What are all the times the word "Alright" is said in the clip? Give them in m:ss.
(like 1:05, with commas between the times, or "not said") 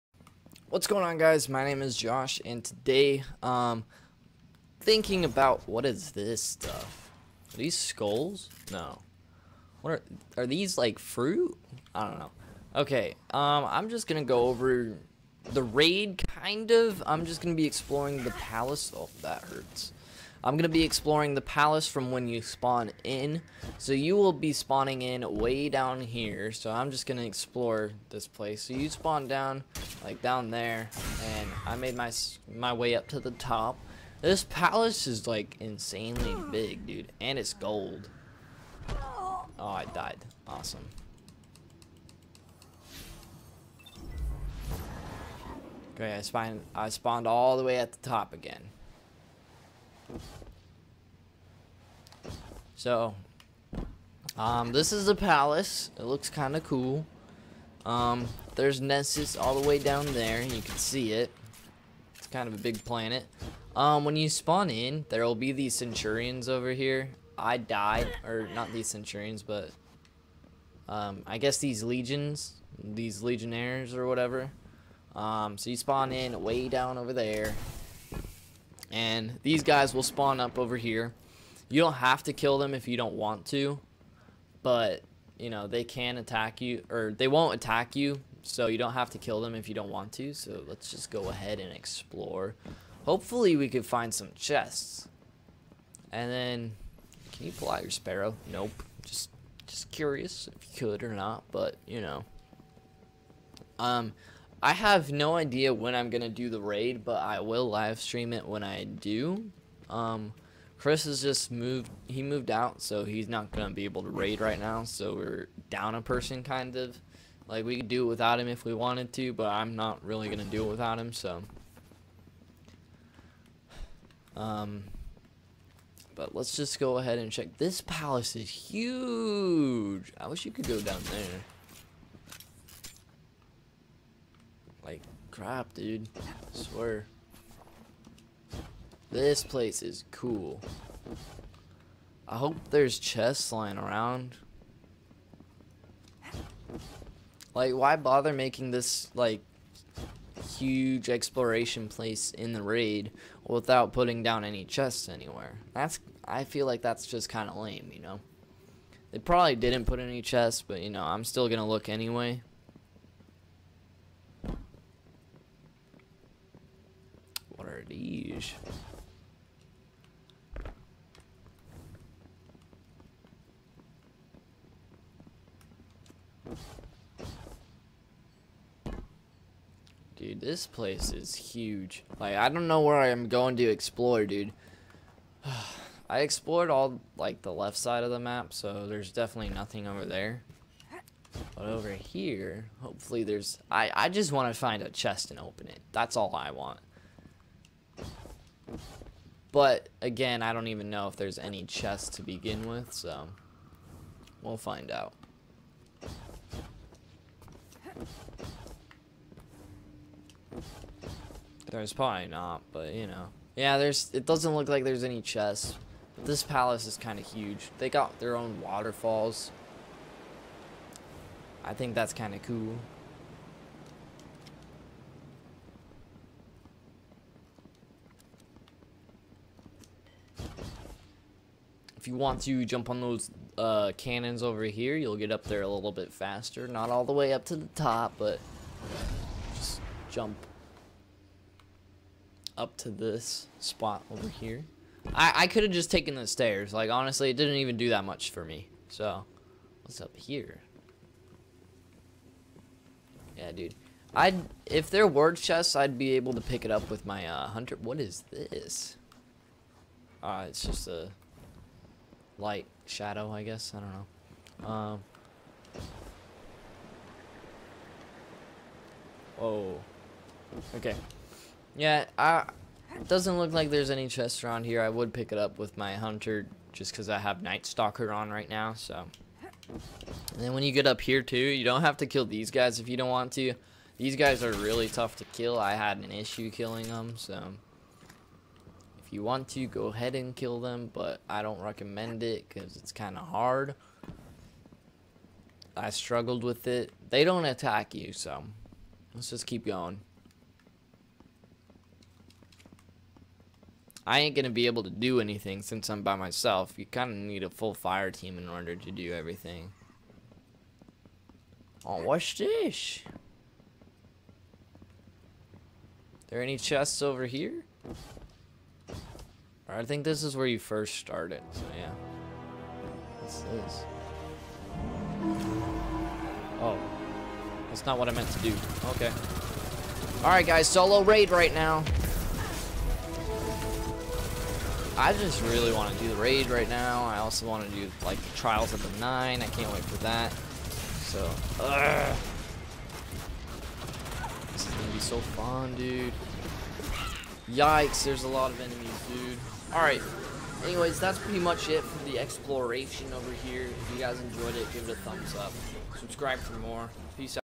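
5:30, 5:49.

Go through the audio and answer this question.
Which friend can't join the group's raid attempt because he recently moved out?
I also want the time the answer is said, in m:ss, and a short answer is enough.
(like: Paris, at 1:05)
Chris, at 1:50.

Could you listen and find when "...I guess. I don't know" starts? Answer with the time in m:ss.
4:23.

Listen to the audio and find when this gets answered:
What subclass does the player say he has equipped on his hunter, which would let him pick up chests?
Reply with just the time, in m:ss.
4:37.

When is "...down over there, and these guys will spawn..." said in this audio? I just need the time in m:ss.
1:16.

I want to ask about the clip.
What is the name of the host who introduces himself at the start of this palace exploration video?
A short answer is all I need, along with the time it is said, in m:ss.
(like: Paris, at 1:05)
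Josh, at 0:01.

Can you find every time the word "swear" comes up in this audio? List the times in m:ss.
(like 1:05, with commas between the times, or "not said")
2:16.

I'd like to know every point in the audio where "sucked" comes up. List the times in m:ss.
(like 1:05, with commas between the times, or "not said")
not said.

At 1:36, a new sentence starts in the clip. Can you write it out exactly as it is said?
And then, can you pull out your sparrow?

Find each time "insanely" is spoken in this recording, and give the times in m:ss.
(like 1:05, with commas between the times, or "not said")
0:35.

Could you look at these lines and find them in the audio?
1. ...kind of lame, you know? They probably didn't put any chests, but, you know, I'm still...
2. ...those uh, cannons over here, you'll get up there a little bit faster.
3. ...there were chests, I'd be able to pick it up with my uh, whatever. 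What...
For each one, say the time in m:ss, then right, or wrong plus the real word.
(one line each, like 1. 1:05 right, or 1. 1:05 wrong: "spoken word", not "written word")
1. 2:37 right
2. 3:52 right
3. 4:14 wrong: "hunter", not "whatever".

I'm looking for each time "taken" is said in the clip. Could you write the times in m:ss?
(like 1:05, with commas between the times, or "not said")
4:05.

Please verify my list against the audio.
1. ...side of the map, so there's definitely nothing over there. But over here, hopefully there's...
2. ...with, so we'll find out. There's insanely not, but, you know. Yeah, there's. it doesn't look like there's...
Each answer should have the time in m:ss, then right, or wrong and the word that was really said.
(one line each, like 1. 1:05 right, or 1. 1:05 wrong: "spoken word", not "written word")
1. 3:07 right
2. 3:22 wrong: "probably", not "insanely".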